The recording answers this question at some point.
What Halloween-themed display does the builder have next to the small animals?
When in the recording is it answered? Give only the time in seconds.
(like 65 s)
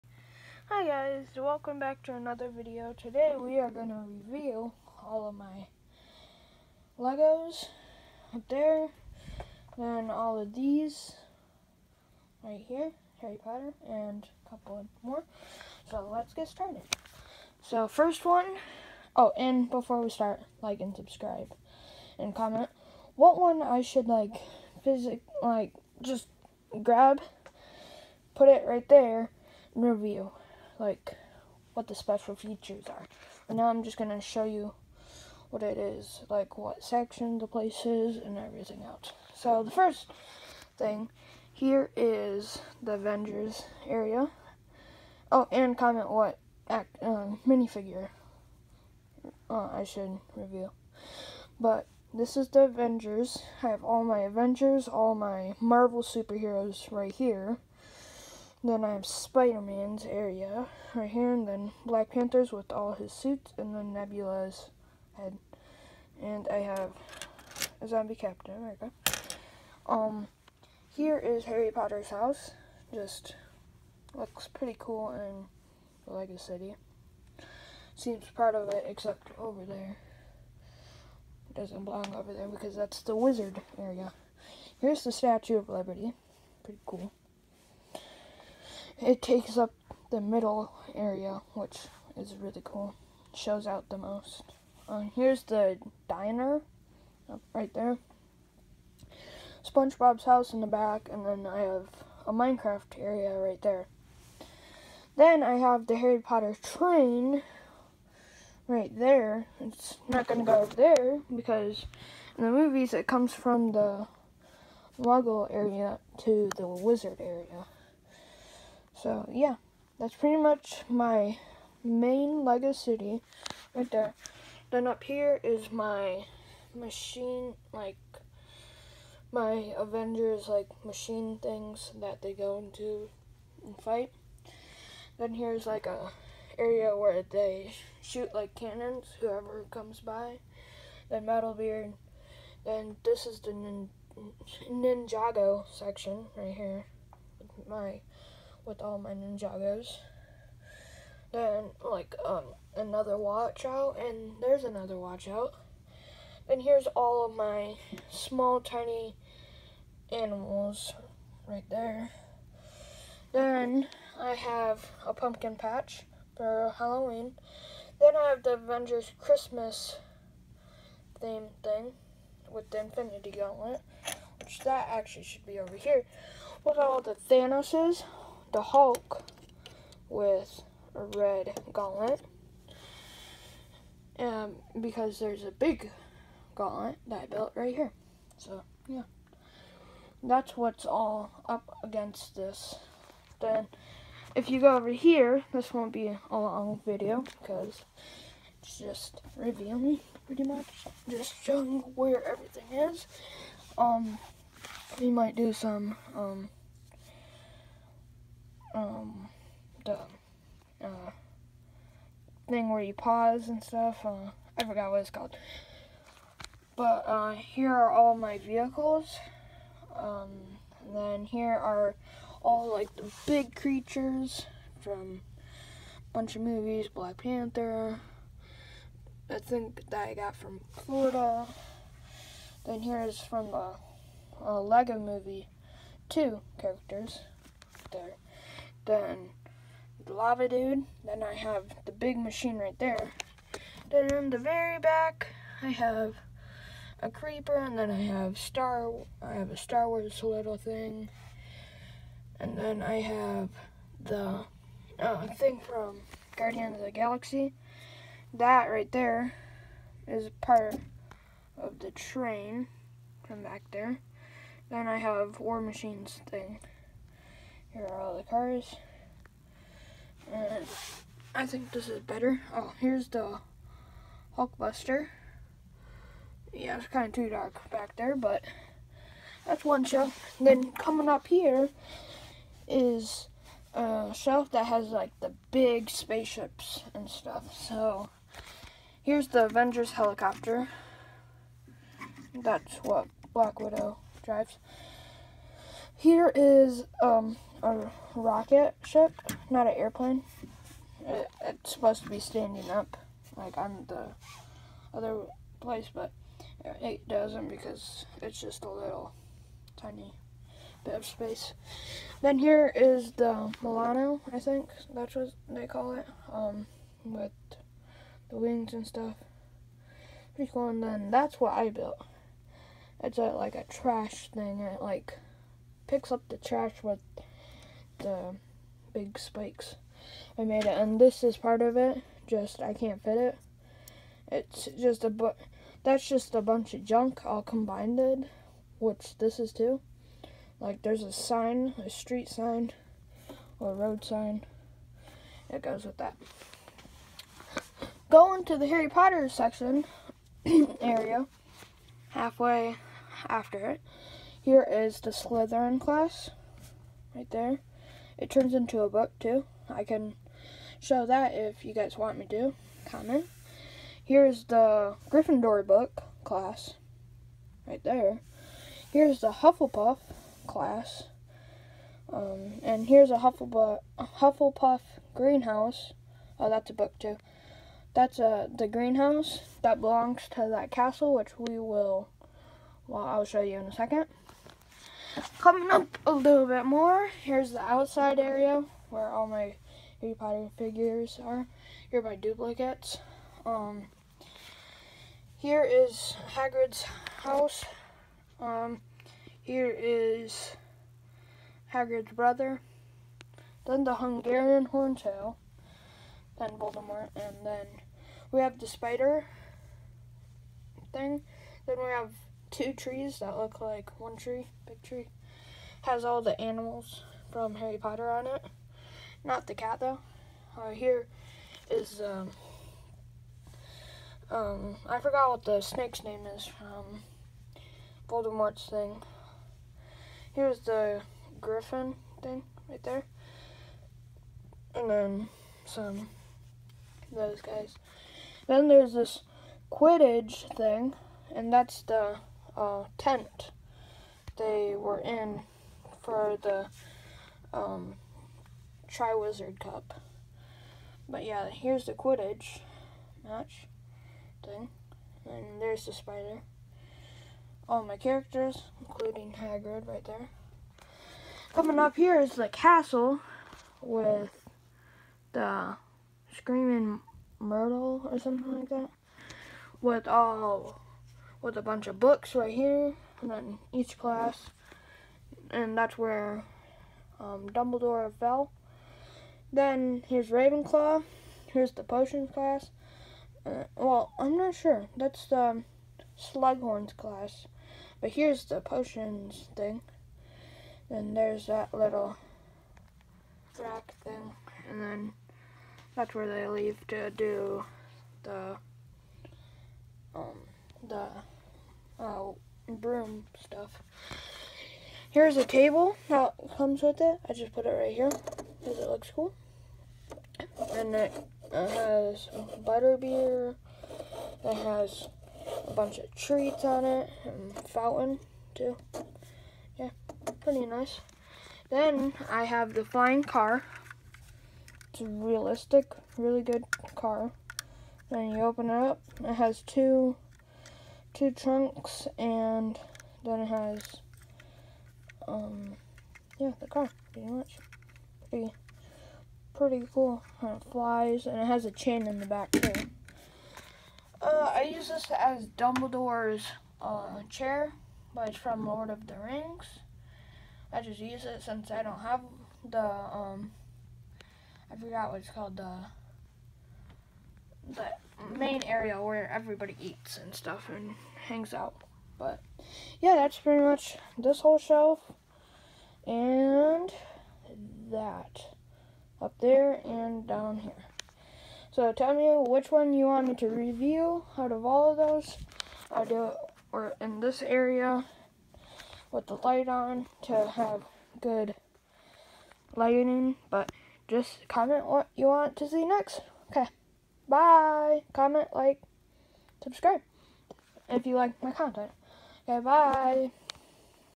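165 s.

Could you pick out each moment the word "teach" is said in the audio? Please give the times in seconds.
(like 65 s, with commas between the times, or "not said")
not said.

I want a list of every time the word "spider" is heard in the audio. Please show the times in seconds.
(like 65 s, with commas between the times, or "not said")
59 s, 408 s, 455 s.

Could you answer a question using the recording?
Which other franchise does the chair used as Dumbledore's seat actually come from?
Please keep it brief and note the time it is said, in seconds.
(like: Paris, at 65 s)
Lord of the Rings, at 548 s.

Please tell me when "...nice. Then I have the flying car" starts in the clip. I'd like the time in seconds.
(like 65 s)
520 s.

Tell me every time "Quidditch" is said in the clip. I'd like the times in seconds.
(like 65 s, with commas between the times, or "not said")
439 s, 451 s.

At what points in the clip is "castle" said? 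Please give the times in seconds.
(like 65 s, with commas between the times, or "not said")
380 s, 462 s.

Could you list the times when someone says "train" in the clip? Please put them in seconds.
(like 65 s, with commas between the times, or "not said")
106 s, 261 s.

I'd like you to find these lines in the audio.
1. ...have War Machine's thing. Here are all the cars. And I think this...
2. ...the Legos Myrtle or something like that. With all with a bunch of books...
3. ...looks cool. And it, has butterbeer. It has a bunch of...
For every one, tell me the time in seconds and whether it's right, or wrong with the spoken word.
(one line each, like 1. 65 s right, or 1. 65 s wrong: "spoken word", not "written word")
1. 264 s right
2. 465 s wrong: "Screaming", not "Legos"
3. 508 s right.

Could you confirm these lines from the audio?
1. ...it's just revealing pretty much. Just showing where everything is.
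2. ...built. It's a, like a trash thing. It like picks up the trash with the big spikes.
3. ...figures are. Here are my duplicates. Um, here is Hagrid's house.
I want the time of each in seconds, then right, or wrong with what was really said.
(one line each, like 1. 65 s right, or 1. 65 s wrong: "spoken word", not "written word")
1. 198 s right
2. 321 s right
3. 390 s right.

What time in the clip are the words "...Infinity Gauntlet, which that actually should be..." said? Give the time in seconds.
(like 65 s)
172 s.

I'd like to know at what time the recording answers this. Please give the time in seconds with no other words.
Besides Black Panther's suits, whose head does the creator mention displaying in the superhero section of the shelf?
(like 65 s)
63 s.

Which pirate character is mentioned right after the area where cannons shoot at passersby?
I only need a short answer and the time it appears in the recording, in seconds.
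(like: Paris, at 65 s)
Metalbeard, at 141 s.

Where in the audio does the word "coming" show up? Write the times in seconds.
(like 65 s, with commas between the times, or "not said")
280 s, 385 s, 461 s.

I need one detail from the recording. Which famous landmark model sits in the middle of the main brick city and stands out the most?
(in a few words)
Statue of Liberty.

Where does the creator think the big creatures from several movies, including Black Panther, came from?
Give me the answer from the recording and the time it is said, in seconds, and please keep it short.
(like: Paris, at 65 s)
Florida, at 230 s.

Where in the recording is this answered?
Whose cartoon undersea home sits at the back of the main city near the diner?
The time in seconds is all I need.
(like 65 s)
99 s.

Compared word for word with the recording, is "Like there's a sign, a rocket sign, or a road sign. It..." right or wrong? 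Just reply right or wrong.
wrong.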